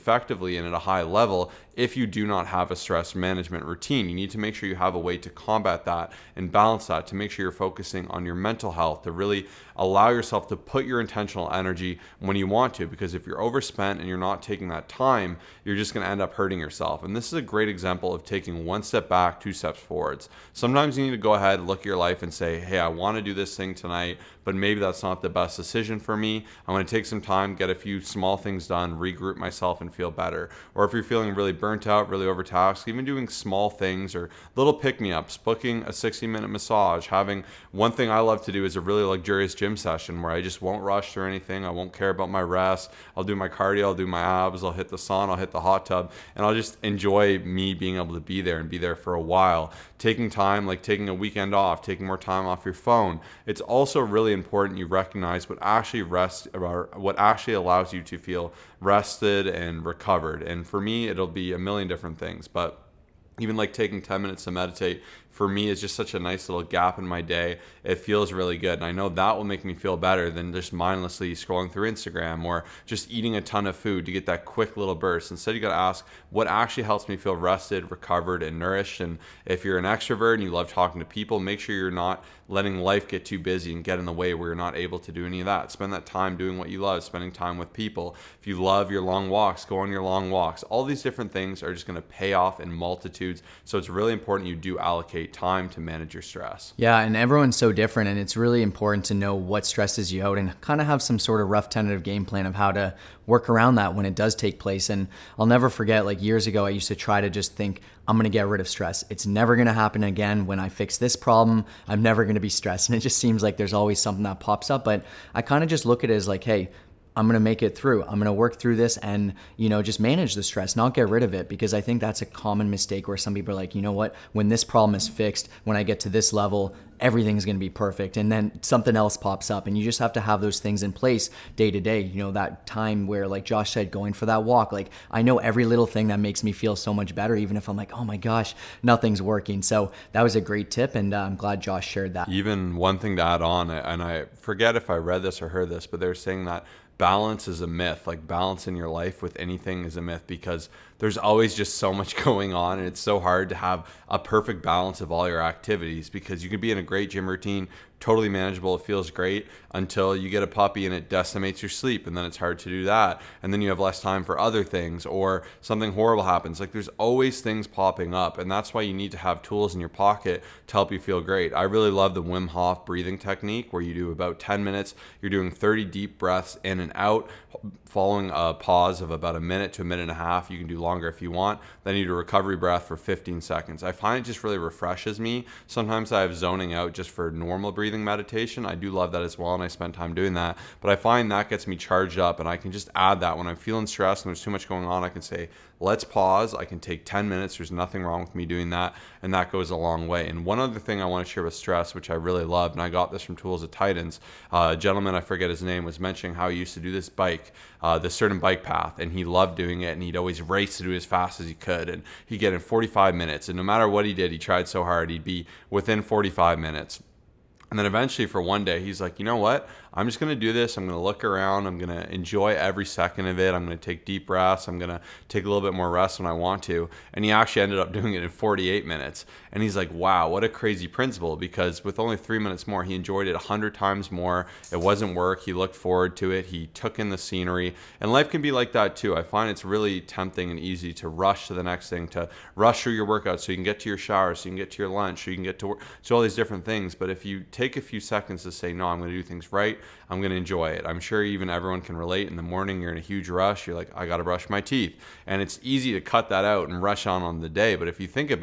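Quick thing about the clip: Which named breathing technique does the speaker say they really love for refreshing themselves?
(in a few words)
Wim Hof.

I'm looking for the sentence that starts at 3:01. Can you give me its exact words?
Then you do a recovery breath for 15 seconds.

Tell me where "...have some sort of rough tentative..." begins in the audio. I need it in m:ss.
1:40.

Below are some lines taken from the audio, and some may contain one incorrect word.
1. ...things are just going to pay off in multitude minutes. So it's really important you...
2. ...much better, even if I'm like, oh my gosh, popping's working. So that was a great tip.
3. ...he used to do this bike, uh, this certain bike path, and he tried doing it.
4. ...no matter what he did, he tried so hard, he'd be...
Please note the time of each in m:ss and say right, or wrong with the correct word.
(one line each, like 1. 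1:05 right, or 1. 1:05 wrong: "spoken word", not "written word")
1. 1:31 wrong: "attitudes", not "minutes"
2. 2:16 wrong: "nothing", not "popping"
3. 3:26 wrong: "loved", not "tried"
4. 3:33 right.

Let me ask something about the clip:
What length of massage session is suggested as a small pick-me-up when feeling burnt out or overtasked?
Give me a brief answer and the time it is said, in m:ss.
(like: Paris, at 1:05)
60 minutes, at 0:35.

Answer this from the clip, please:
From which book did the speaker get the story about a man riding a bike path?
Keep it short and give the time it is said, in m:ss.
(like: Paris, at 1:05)
Tools of Titans, at 3:23.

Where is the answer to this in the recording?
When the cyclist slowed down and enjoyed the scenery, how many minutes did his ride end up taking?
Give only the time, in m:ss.
3:48.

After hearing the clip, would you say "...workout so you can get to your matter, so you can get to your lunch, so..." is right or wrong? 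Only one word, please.
wrong.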